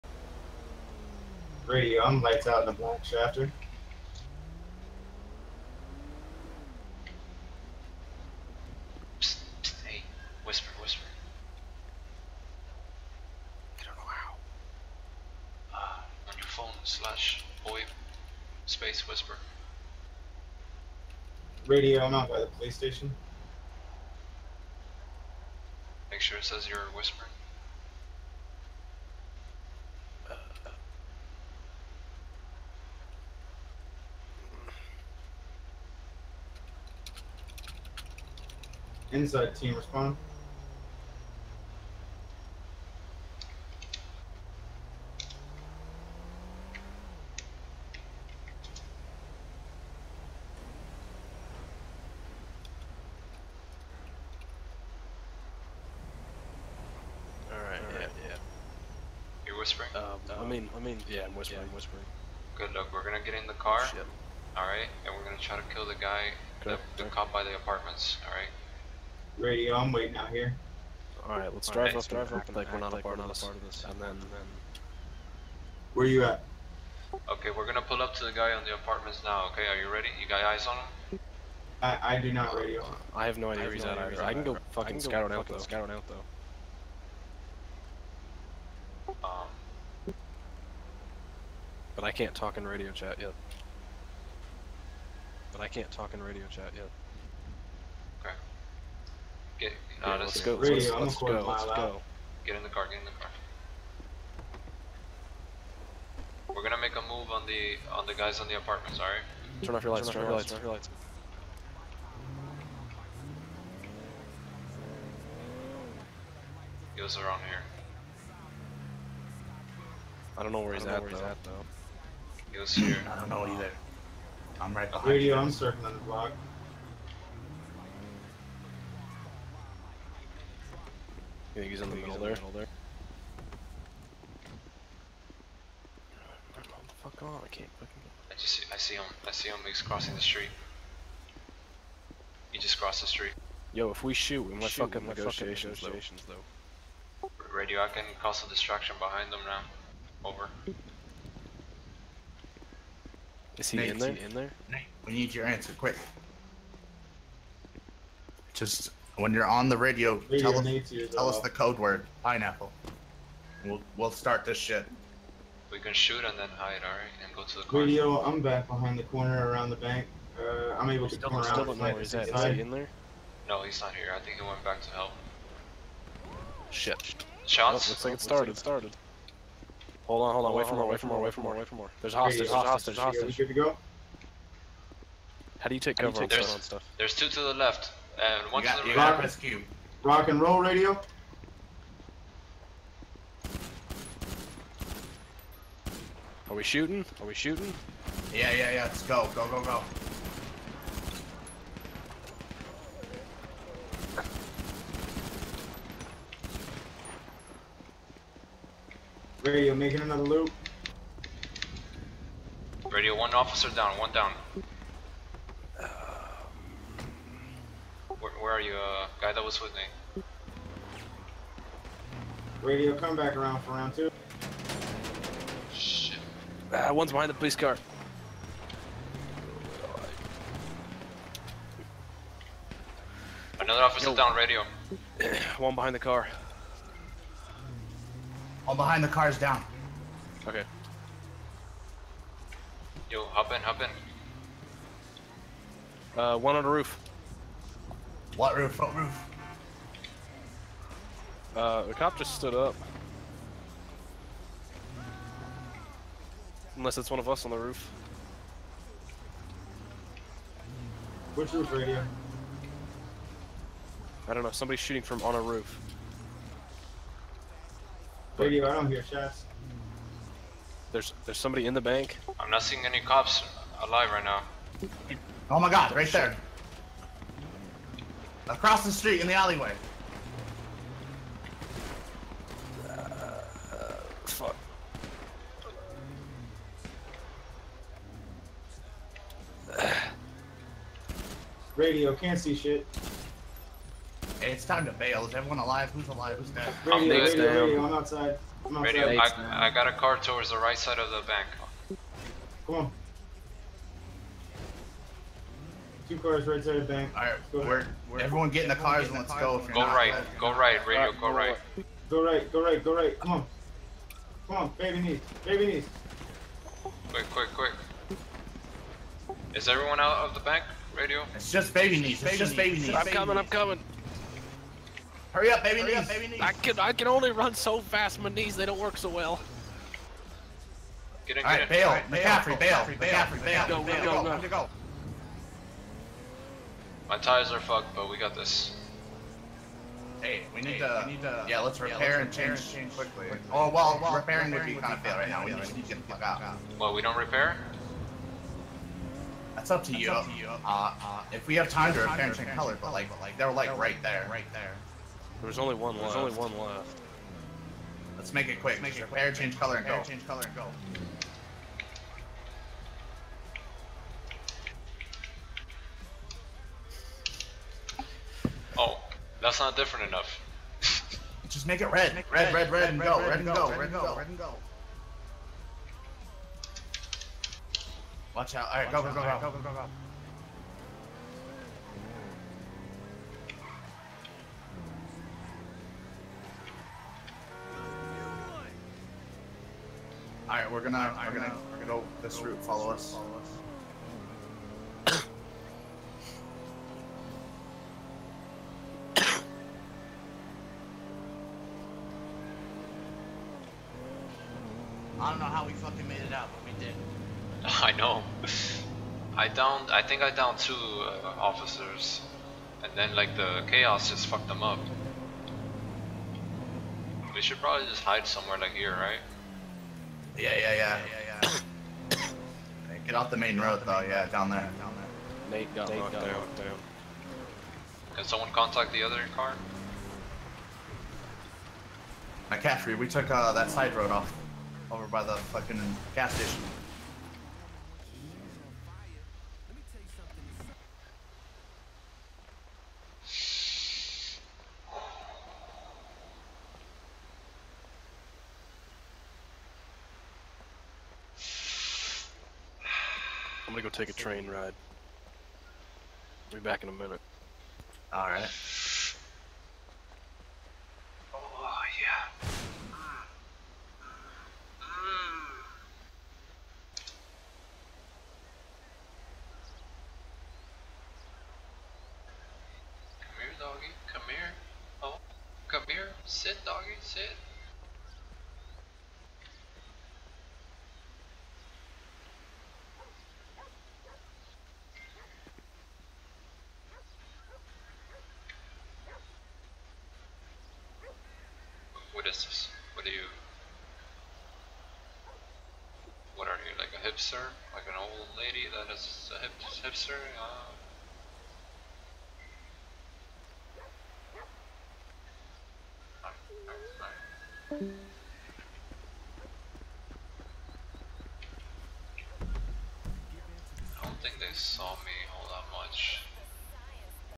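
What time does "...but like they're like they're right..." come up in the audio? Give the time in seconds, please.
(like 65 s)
353 s.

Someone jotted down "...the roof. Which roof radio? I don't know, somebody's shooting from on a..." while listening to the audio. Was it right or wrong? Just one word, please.
right.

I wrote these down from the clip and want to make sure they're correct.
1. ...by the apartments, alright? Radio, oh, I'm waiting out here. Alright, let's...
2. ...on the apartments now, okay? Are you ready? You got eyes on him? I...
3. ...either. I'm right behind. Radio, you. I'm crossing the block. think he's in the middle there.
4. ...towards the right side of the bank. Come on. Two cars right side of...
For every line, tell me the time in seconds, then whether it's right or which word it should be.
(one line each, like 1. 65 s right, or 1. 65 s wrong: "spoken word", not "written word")
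1. 67 s right
2. 78 s right
3. 123 s wrong: "circling", not "crossing"
4. 300 s right.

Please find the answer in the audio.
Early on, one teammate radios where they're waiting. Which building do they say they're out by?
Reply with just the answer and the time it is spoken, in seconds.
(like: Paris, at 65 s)
The police station, at 22 s.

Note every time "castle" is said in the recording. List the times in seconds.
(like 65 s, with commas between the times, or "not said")
not said.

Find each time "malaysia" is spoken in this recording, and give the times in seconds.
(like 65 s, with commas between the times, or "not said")
not said.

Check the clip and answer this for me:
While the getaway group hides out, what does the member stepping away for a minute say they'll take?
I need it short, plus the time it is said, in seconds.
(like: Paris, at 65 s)
A train ride, at 454 s.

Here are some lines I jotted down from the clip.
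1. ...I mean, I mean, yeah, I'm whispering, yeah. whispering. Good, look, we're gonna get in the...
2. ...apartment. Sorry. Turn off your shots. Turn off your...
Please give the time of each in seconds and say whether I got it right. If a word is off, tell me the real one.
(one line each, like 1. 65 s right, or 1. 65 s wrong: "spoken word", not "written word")
1. 60 s right
2. 108 s wrong: "lights", not "shots".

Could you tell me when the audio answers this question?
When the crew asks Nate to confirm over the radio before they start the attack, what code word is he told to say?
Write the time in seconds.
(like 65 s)
162 s.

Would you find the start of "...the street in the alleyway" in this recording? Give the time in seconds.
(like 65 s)
278 s.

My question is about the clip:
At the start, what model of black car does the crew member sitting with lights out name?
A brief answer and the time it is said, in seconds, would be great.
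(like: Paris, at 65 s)
Schafter, at 3 s.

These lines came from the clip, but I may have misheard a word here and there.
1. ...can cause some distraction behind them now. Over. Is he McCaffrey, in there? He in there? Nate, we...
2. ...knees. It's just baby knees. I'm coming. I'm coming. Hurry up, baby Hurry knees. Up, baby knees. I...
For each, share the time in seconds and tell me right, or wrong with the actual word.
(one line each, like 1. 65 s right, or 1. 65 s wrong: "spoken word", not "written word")
1. 147 s wrong: "Nate", not "McCaffrey"
2. 322 s right.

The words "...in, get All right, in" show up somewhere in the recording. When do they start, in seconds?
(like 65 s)
331 s.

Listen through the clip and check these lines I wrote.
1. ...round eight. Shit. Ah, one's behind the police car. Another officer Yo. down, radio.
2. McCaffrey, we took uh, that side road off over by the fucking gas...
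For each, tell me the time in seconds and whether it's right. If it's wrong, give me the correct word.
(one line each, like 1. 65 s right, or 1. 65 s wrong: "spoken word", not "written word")
1. 223 s wrong: "two", not "eight"
2. 432 s right.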